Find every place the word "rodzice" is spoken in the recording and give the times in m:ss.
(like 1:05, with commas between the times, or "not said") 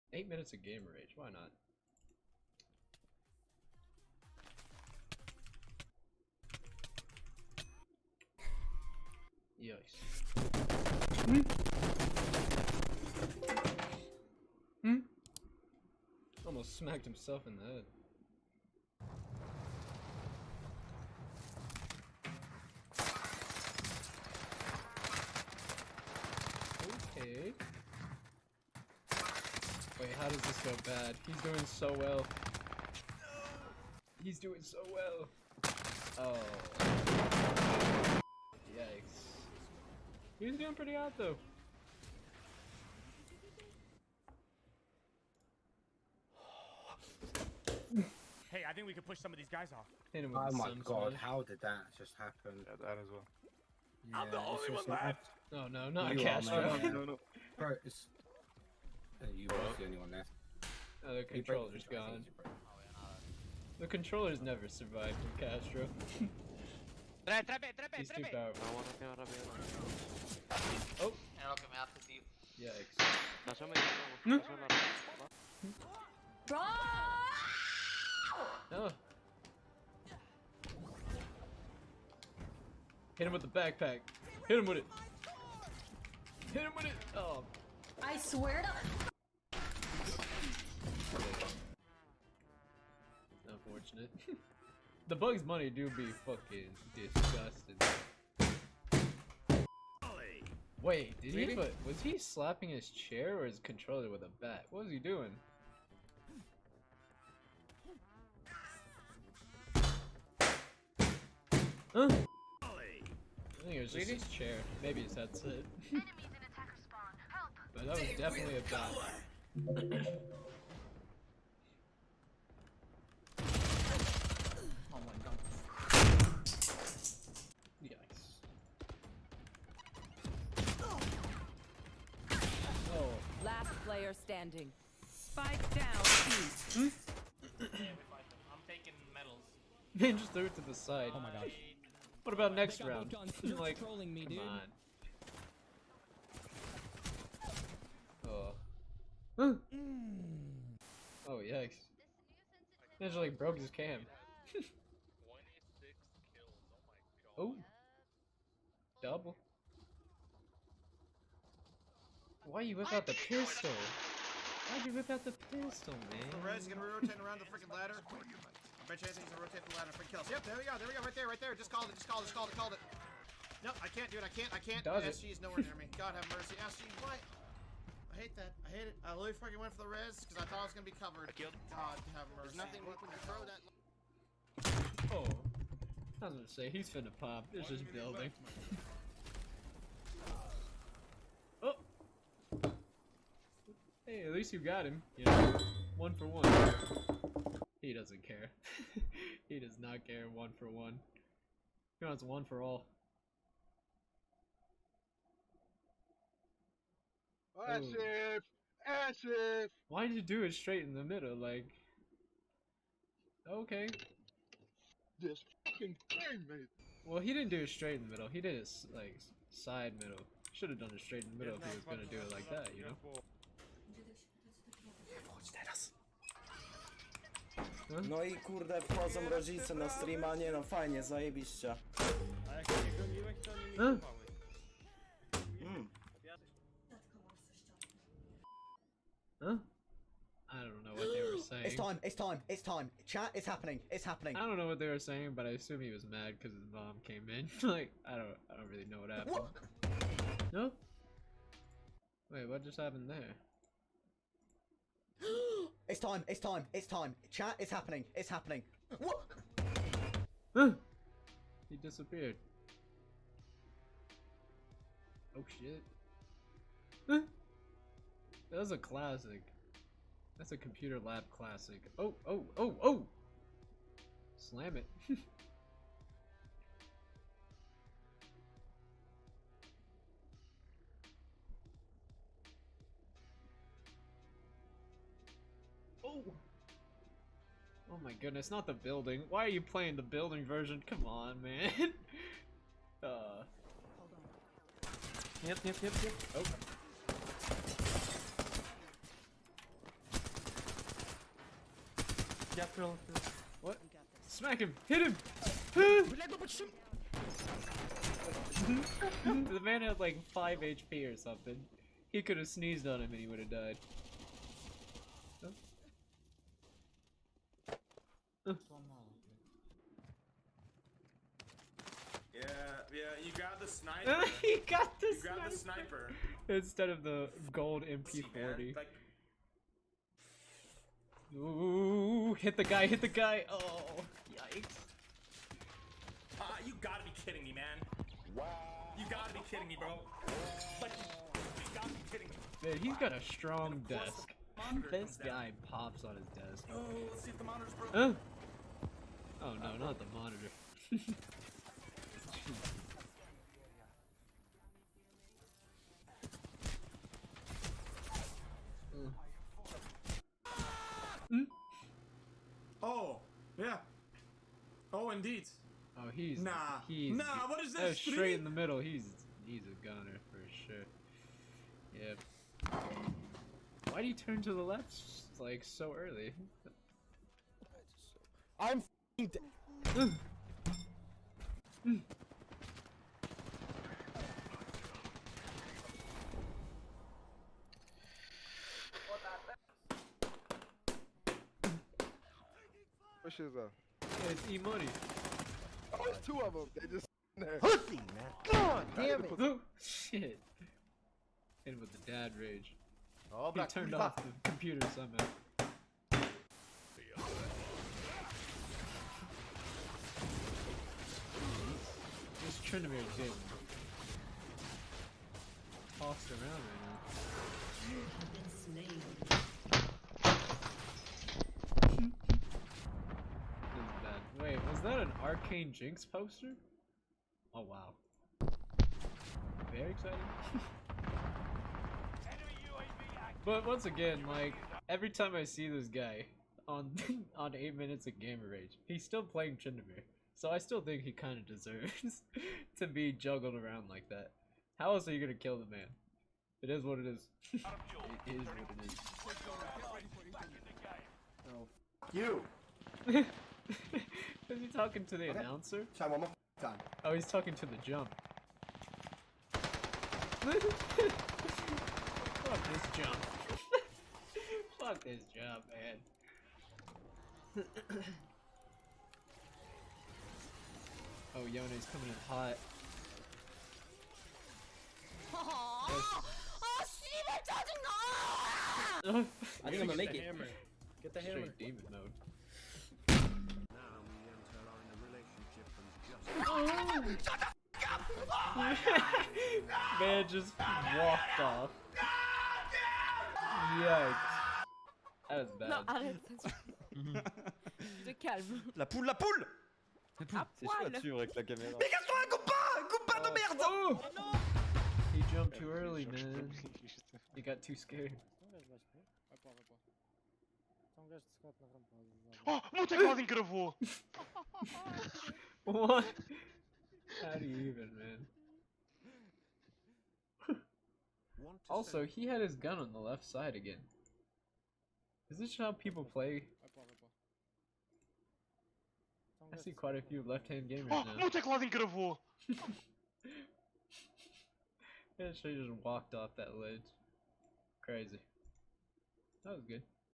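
3:49.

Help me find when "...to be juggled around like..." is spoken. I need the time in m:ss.
7:22.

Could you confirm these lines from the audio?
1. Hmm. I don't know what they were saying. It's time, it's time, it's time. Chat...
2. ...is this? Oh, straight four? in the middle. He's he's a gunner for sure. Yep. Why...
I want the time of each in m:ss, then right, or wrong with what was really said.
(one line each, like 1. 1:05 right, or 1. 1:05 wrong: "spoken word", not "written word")
1. 3:59 right
2. 6:07 wrong: "three", not "four".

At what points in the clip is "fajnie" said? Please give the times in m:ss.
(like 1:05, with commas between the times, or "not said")
3:50.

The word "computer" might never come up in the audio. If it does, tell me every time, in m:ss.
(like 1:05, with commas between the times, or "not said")
4:30, 6:44.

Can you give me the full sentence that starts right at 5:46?
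Oh, let's see if the monitor's broken.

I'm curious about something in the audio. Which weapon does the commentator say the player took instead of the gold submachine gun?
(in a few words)
The sniper.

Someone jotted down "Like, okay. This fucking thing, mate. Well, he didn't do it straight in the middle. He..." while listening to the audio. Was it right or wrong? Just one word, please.
right.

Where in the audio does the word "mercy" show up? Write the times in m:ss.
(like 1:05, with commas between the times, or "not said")
2:56, 3:02.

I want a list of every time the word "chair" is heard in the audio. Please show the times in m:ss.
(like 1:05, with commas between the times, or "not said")
1:42, 1:54.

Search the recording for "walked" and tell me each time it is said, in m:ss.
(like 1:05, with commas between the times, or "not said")
8:10, 8:55.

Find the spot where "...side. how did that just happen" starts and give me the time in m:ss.
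0:51.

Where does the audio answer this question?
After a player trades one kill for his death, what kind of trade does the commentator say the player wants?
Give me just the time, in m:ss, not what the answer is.
3:21.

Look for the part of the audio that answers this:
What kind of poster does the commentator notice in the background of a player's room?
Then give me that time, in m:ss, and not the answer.
7:05.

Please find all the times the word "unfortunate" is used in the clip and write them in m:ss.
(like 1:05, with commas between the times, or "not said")
1:33.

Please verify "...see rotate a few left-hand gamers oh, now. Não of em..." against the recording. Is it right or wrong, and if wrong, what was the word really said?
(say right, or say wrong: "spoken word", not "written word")
wrong: "quite", not "rotate".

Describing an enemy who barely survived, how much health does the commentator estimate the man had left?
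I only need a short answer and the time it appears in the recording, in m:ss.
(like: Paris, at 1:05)
5 HP, at 5:10.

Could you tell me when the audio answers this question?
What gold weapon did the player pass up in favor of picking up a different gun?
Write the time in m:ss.
5:27.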